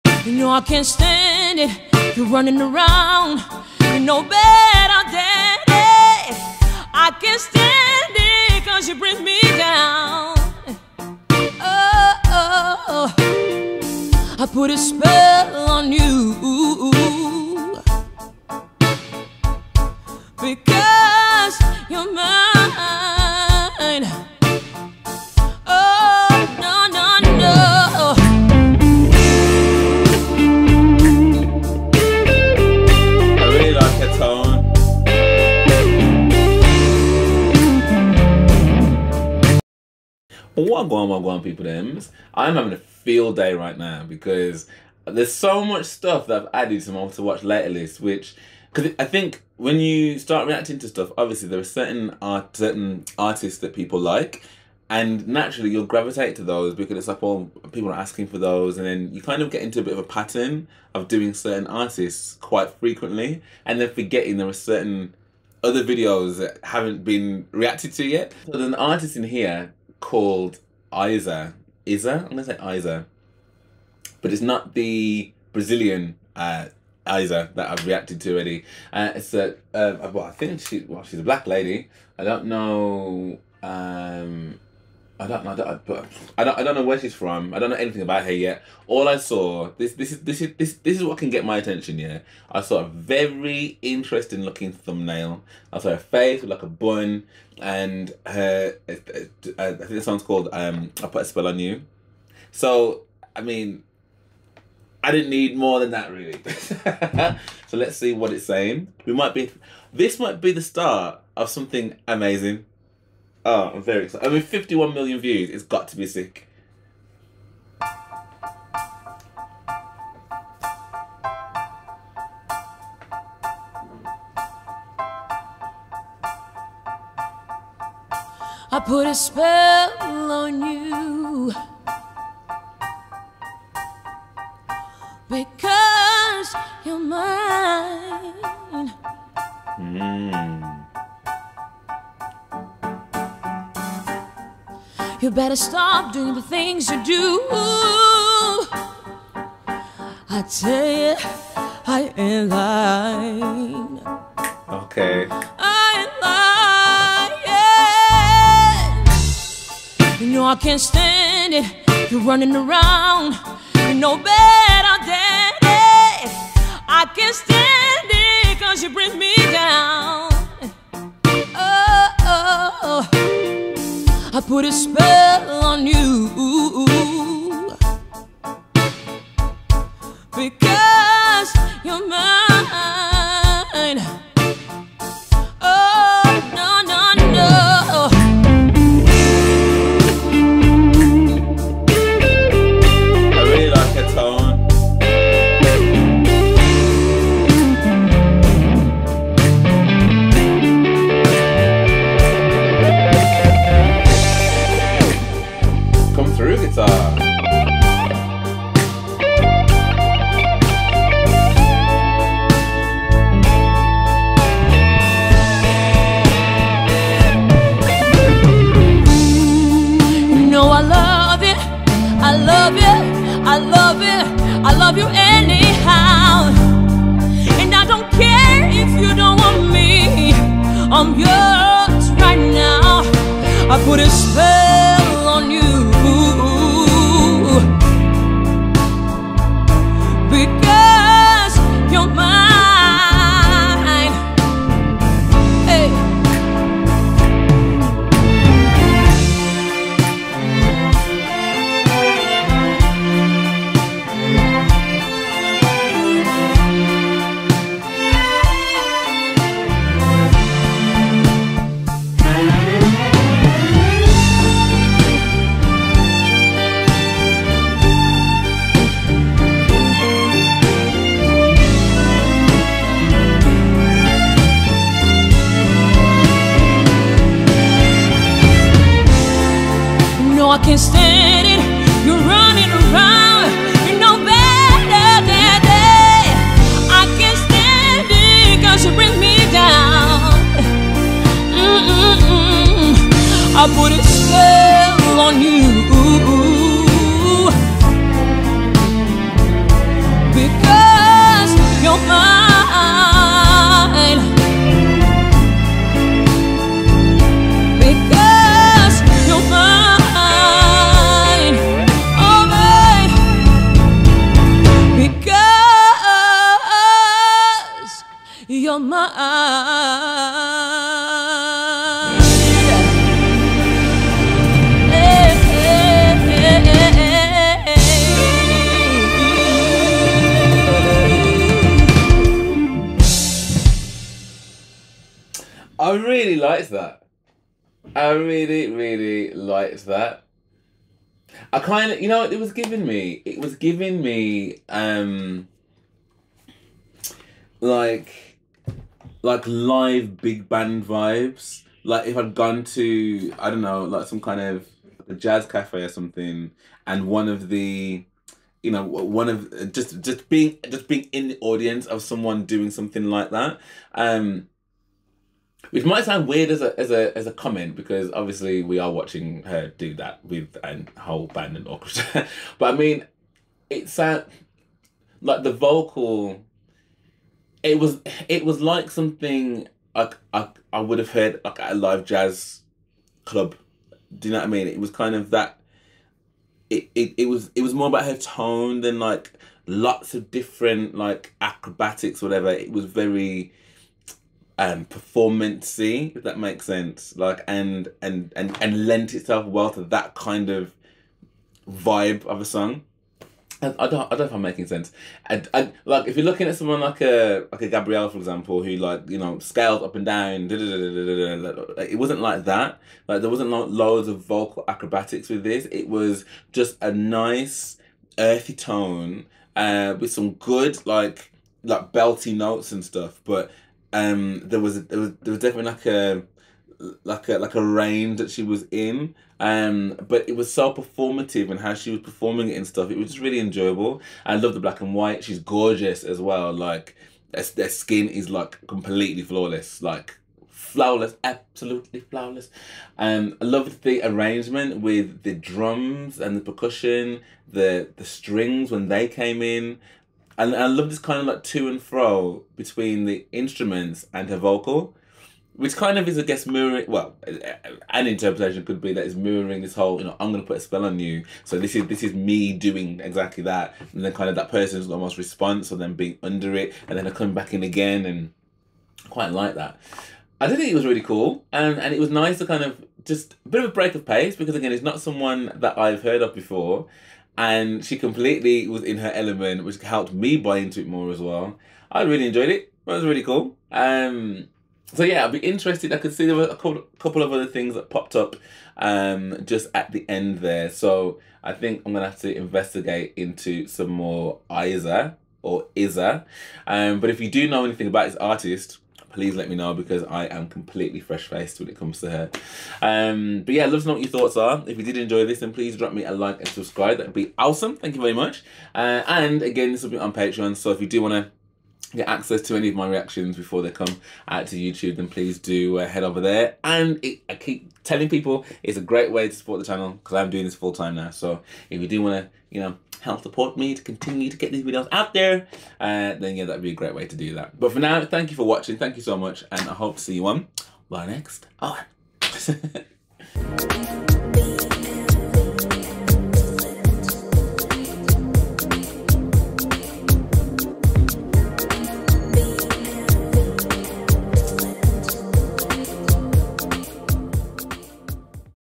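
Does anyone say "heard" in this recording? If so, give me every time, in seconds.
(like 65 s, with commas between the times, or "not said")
381 s, 476 s.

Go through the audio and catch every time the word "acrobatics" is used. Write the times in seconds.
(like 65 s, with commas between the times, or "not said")
391 s, 414 s.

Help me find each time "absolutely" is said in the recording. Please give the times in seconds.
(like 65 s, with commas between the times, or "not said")
441 s.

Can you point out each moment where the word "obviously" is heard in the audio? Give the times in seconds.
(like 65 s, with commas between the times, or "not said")
51 s, 368 s.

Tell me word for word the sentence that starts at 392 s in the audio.
It was very um performancy if that makes sense.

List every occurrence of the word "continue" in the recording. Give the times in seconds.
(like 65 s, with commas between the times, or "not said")
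523 s.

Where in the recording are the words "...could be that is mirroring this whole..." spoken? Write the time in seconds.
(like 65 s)
458 s.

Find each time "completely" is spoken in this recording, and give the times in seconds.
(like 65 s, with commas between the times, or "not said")
438 s, 477 s, 500 s.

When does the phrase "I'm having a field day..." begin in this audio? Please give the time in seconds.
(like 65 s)
42 s.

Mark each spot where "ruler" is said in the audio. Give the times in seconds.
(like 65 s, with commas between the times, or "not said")
not said.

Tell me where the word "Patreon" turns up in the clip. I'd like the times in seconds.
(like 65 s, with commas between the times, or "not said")
510 s.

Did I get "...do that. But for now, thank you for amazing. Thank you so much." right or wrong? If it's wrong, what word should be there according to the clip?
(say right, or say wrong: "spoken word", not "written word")
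wrong: "watching", not "amazing".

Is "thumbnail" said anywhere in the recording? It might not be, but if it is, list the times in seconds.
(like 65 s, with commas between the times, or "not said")
94 s.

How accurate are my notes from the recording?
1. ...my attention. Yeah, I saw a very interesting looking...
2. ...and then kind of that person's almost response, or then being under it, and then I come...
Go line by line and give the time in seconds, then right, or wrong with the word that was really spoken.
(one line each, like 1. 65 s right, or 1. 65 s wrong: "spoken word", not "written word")
1. 91 s right
2. 463 s right.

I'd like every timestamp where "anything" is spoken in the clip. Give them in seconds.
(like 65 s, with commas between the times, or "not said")
87 s, 497 s.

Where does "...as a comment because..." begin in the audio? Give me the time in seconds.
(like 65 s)
367 s.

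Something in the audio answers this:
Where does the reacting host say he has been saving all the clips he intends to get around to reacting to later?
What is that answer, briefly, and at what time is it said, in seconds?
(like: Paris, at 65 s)
Watch later list, at 47 s.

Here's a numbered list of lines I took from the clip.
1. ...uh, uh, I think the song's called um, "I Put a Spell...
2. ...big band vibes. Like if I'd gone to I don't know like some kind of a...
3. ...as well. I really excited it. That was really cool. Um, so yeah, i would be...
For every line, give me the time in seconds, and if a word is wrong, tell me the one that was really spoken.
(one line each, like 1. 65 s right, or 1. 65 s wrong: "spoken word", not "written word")
1. 98 s right
2. 350 s right
3. 481 s wrong: "enjoyed", not "excited".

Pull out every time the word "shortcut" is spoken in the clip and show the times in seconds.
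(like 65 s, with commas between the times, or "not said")
not said.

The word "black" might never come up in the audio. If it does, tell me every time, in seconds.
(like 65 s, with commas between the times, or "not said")
81 s, 434 s.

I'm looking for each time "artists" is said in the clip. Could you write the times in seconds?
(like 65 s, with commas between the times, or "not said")
53 s, 61 s, 68 s, 498 s.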